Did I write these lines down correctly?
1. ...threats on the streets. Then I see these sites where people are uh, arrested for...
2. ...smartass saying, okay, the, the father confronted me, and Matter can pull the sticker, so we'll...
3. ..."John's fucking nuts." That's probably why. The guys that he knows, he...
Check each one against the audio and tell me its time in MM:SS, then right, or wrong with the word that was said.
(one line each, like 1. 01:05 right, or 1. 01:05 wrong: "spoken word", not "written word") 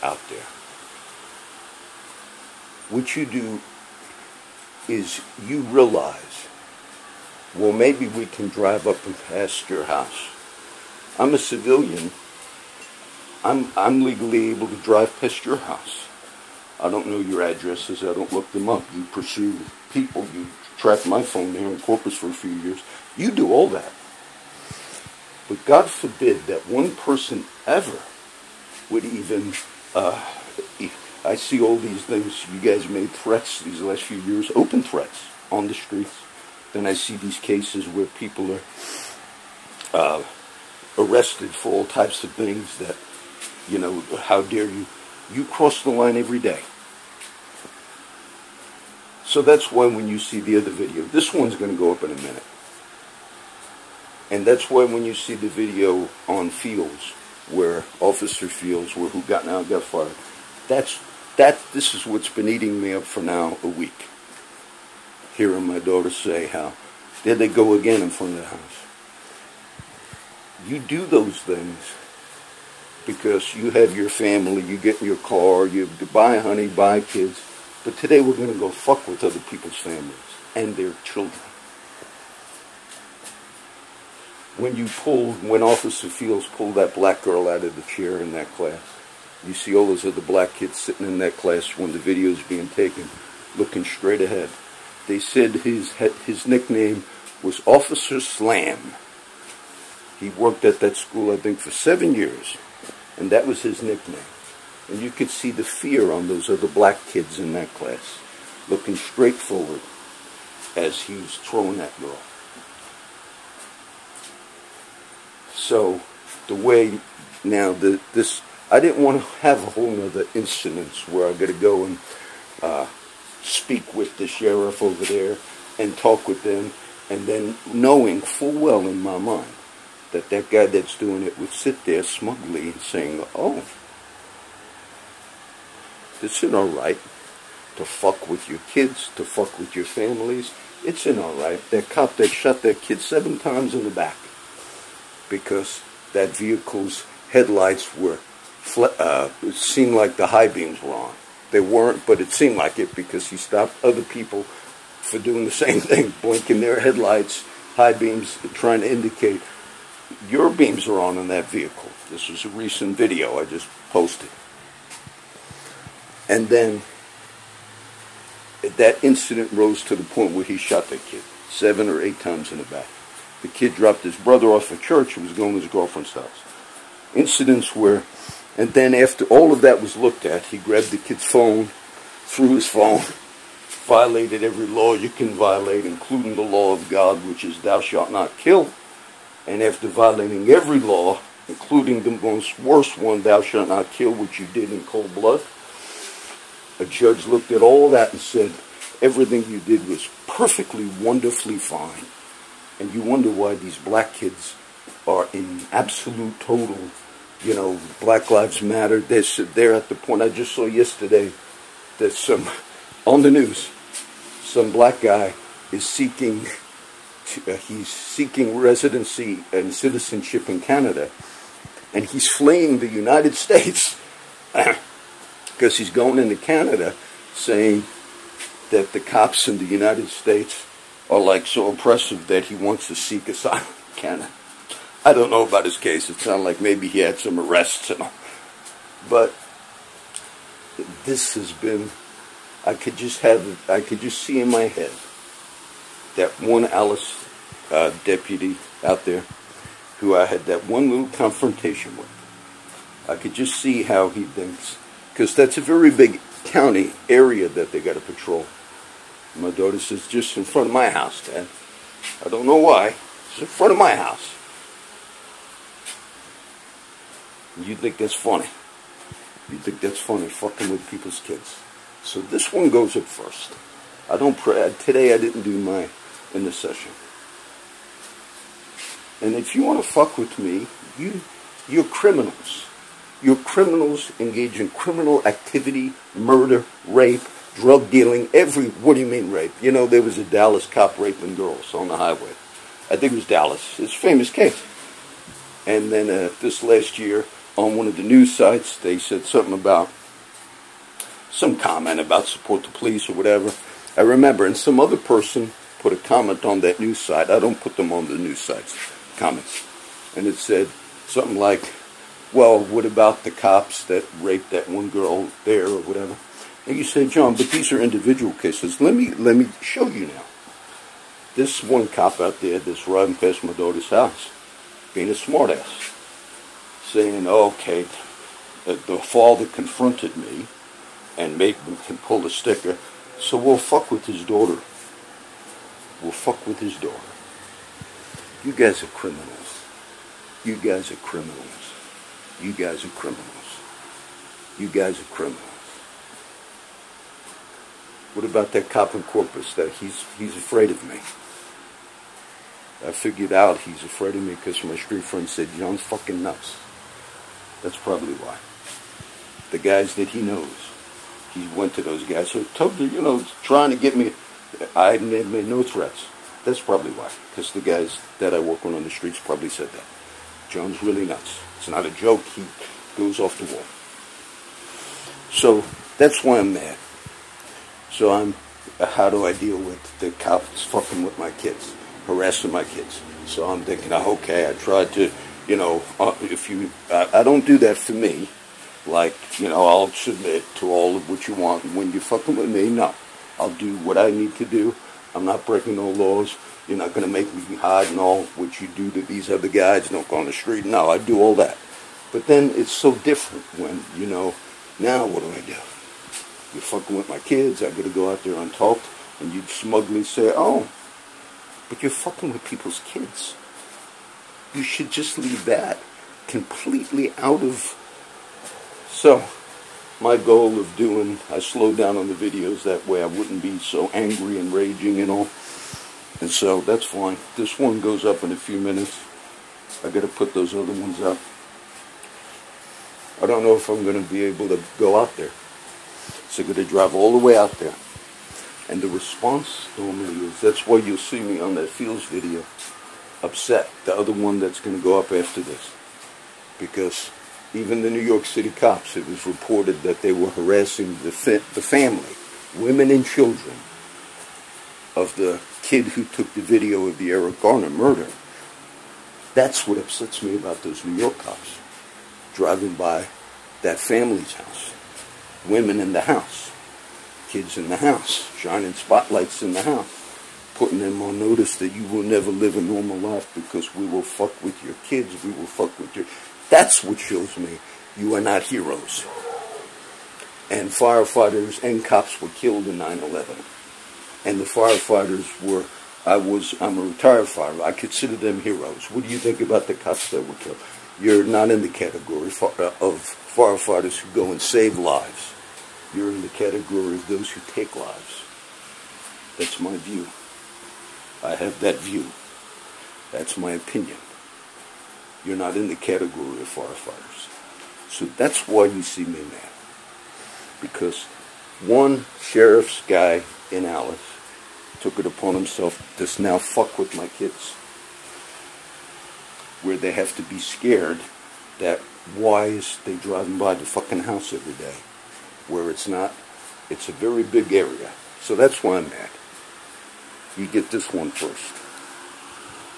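1. 00:34 wrong: "cases", not "sites"
2. 05:25 wrong: "Maitland", not "Matter"
3. 05:55 right.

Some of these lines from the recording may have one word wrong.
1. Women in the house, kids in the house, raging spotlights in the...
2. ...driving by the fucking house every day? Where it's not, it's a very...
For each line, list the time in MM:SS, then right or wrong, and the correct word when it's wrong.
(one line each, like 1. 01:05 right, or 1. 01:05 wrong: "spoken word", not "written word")
1. 07:45 wrong: "shining", not "raging"
2. 08:42 right.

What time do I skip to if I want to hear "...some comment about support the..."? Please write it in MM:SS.
05:01.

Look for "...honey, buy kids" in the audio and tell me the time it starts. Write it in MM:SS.
01:16.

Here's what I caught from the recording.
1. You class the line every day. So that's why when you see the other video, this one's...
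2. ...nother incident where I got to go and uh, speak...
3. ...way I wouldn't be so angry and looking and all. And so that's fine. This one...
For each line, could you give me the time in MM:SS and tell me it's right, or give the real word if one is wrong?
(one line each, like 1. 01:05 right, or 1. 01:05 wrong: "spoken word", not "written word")
1. 00:45 wrong: "cross", not "class"
2. 01:59 right
3. 07:02 wrong: "raging", not "looking".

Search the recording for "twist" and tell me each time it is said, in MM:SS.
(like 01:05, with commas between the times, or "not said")
not said.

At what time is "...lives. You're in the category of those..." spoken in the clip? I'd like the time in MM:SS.
08:14.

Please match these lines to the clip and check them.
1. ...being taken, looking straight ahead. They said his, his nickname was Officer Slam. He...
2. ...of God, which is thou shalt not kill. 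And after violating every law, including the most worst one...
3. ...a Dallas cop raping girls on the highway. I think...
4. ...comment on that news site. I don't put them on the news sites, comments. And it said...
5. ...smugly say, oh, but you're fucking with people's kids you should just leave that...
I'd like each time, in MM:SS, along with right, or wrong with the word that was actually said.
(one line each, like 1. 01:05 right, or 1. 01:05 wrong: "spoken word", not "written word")
1. 01:32 right
2. 03:06 right
3. 04:50 right
4. 05:05 right
5. 06:49 right.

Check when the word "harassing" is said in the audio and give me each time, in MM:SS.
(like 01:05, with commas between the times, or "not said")
06:22, 07:30.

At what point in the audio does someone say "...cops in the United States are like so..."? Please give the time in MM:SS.
03:48.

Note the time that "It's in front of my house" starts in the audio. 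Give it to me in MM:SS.
04:23.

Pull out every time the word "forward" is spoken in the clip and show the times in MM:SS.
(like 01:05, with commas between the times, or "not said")
01:49.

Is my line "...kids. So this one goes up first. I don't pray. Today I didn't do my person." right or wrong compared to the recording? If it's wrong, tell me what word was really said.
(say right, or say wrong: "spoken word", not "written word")
wrong: "intercession", not "person".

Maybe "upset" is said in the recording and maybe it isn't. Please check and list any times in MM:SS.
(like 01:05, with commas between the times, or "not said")
07:23, 07:39.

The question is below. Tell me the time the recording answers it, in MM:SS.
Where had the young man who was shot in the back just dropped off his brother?
02:54.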